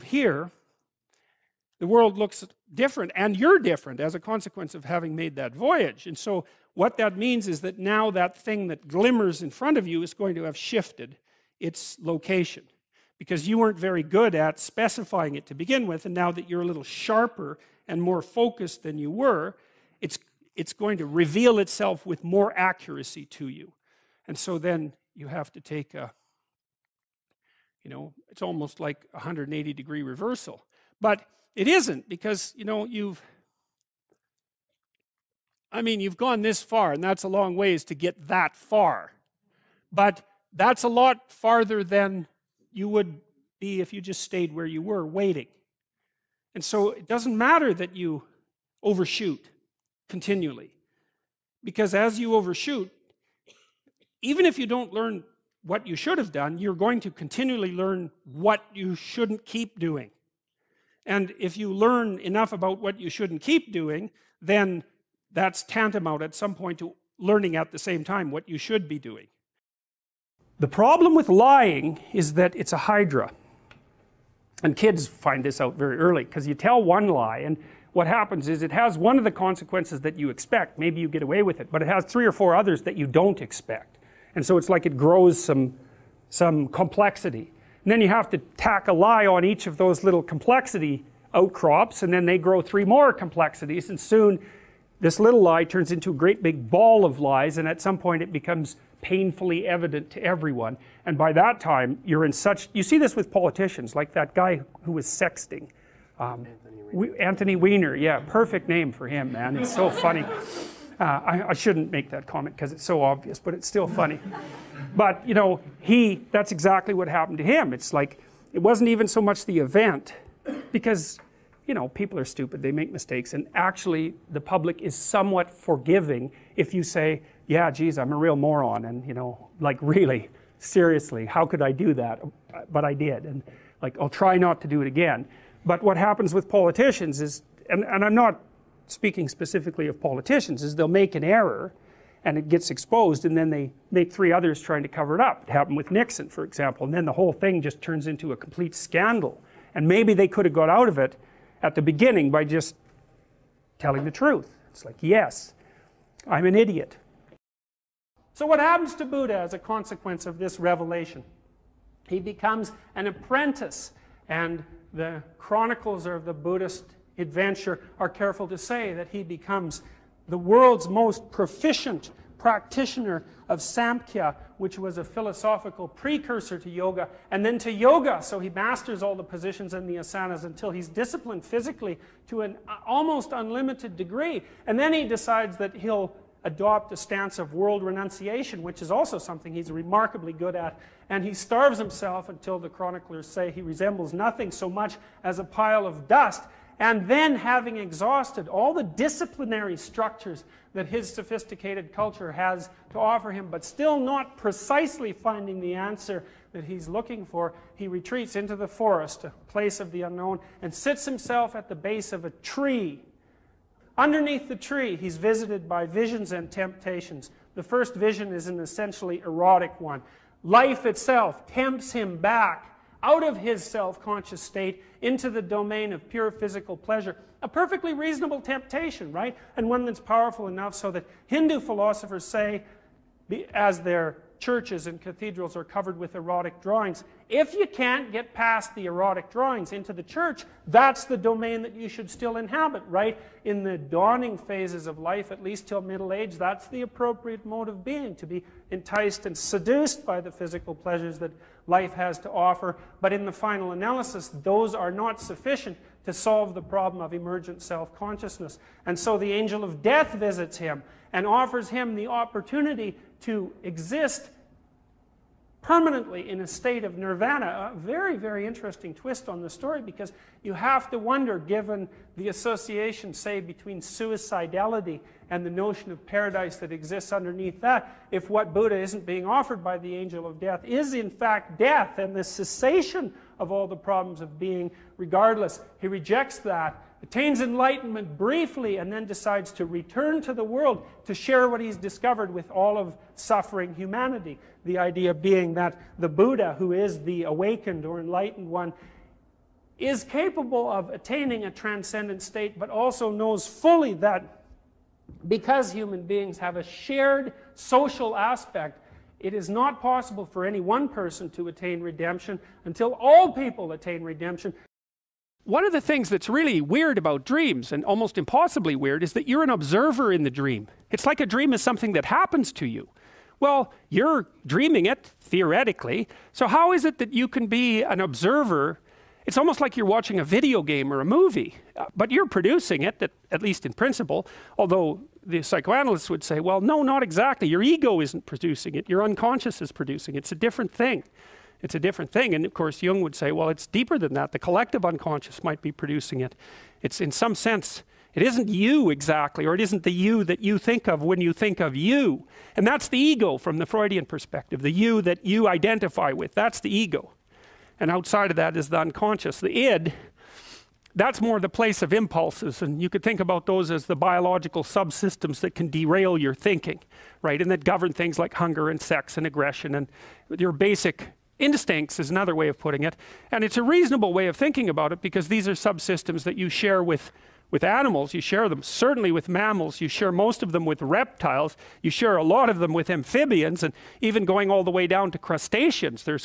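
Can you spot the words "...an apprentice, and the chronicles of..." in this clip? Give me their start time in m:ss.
2:42.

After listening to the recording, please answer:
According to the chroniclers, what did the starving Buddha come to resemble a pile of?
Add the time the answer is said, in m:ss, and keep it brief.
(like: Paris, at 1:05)
dust, at 3:16.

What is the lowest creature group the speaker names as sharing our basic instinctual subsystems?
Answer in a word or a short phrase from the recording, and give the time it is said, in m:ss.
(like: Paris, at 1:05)
crustaceans, at 6:25.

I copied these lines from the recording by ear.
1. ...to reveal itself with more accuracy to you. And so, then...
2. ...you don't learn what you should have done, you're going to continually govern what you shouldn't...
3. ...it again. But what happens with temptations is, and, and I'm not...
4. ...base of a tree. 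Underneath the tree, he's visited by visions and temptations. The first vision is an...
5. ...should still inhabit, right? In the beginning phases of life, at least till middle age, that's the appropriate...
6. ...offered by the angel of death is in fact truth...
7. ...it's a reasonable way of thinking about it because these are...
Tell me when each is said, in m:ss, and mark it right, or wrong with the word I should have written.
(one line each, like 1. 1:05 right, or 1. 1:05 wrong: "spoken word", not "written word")
1. 0:20 right
2. 0:54 wrong: "learn", not "govern"
3. 2:14 wrong: "politicians", not "temptations"
4. 3:31 right
5. 4:01 wrong: "dawning", not "beginning"
6. 4:39 wrong: "death", not "truth"
7. 6:13 right.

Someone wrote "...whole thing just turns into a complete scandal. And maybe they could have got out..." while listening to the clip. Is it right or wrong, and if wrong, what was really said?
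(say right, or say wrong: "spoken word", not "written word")
right.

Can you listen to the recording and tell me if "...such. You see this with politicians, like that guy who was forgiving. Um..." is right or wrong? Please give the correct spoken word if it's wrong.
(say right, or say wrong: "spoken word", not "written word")
wrong: "sexting", not "forgiving".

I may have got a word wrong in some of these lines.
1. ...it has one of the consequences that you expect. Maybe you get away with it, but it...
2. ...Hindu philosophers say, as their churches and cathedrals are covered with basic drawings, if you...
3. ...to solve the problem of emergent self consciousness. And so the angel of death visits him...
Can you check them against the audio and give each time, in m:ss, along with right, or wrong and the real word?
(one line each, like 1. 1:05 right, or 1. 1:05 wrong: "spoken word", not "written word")
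1. 1:18 right
2. 3:51 wrong: "erotic", not "basic"
3. 4:16 right.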